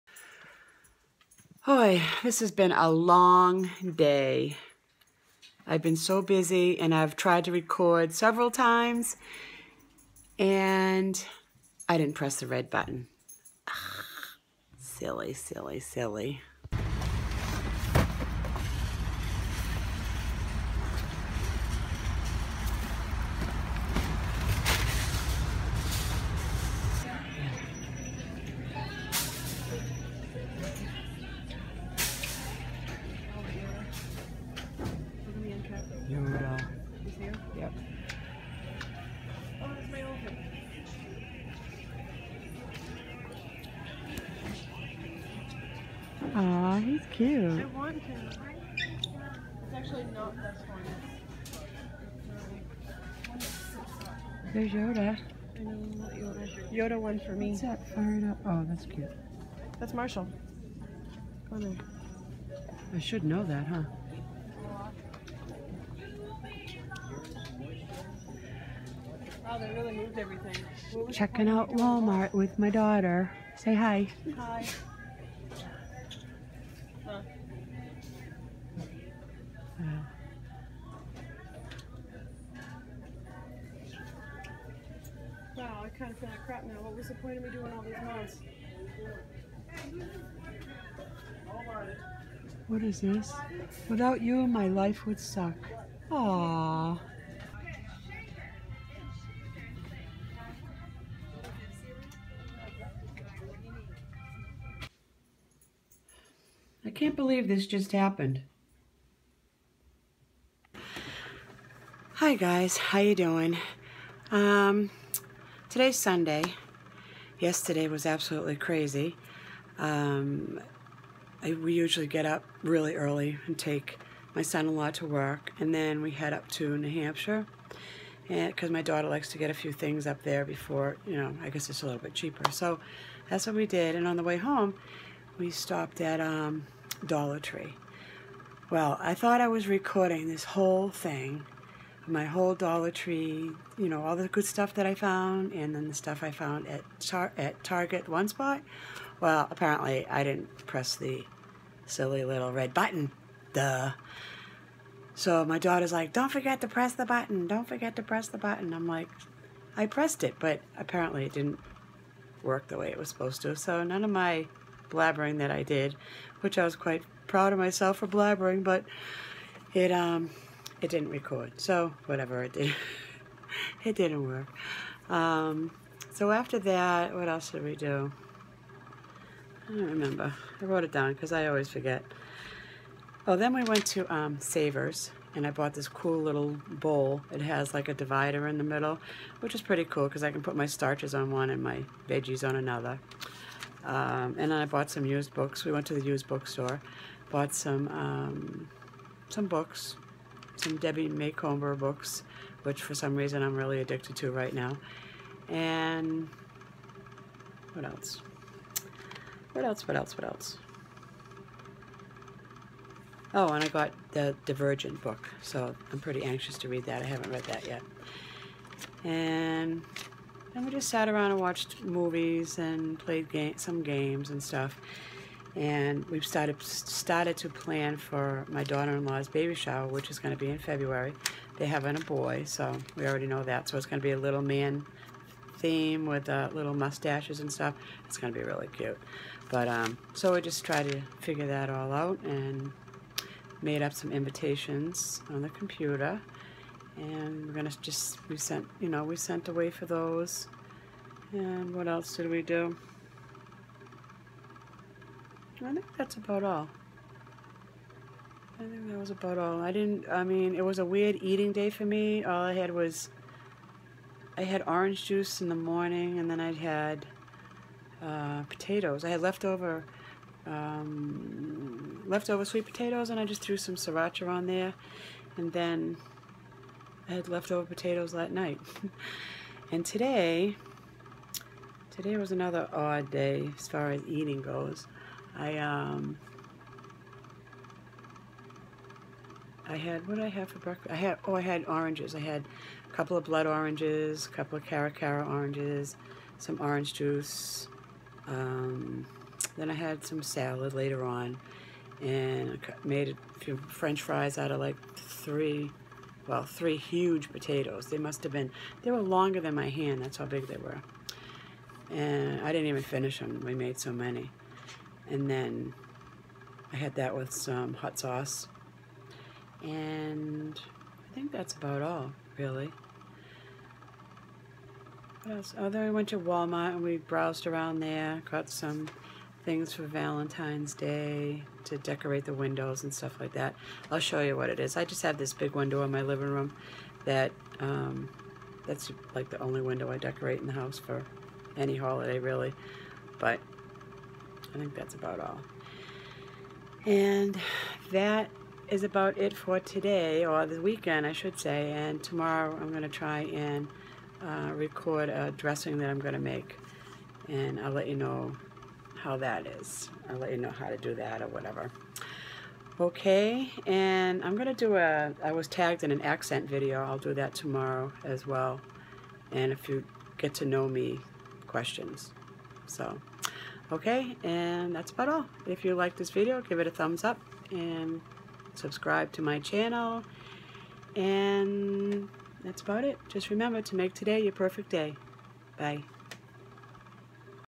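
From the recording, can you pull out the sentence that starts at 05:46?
And that is about it for today, or the weekend, I should say.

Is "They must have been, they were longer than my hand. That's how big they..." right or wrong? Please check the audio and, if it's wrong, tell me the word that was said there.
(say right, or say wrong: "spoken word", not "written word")
right.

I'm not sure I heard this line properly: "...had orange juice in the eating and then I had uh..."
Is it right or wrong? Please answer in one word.
wrong.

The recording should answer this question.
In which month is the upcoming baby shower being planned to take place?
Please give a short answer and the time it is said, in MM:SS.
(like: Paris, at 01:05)
February, at 03:50.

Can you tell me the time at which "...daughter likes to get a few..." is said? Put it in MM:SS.
02:08.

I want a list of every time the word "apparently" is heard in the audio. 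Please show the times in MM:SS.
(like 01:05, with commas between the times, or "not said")
02:29, 02:40.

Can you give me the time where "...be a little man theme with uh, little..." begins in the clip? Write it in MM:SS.
03:54.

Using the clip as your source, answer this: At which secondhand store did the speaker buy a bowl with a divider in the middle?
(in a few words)
Savers.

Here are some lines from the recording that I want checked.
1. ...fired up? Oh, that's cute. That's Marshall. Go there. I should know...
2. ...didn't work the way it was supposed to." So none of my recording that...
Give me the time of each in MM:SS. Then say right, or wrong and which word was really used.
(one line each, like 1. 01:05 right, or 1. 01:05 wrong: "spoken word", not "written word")
1. 00:57 right
2. 02:41 wrong: "blabbering", not "recording".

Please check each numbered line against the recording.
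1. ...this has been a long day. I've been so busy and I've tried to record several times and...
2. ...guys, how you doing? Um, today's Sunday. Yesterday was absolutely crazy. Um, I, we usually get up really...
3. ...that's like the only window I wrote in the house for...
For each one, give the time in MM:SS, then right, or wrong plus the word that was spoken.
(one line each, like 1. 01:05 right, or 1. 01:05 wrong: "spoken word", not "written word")
1. 00:02 right
2. 01:52 right
3. 05:38 wrong: "decorate", not "wrote".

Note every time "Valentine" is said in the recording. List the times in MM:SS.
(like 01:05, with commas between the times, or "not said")
05:29.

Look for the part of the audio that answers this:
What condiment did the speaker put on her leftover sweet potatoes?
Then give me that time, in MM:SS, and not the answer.
04:33.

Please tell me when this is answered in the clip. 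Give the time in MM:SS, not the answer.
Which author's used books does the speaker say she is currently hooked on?
03:20.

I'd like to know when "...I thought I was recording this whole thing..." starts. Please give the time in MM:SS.
02:19.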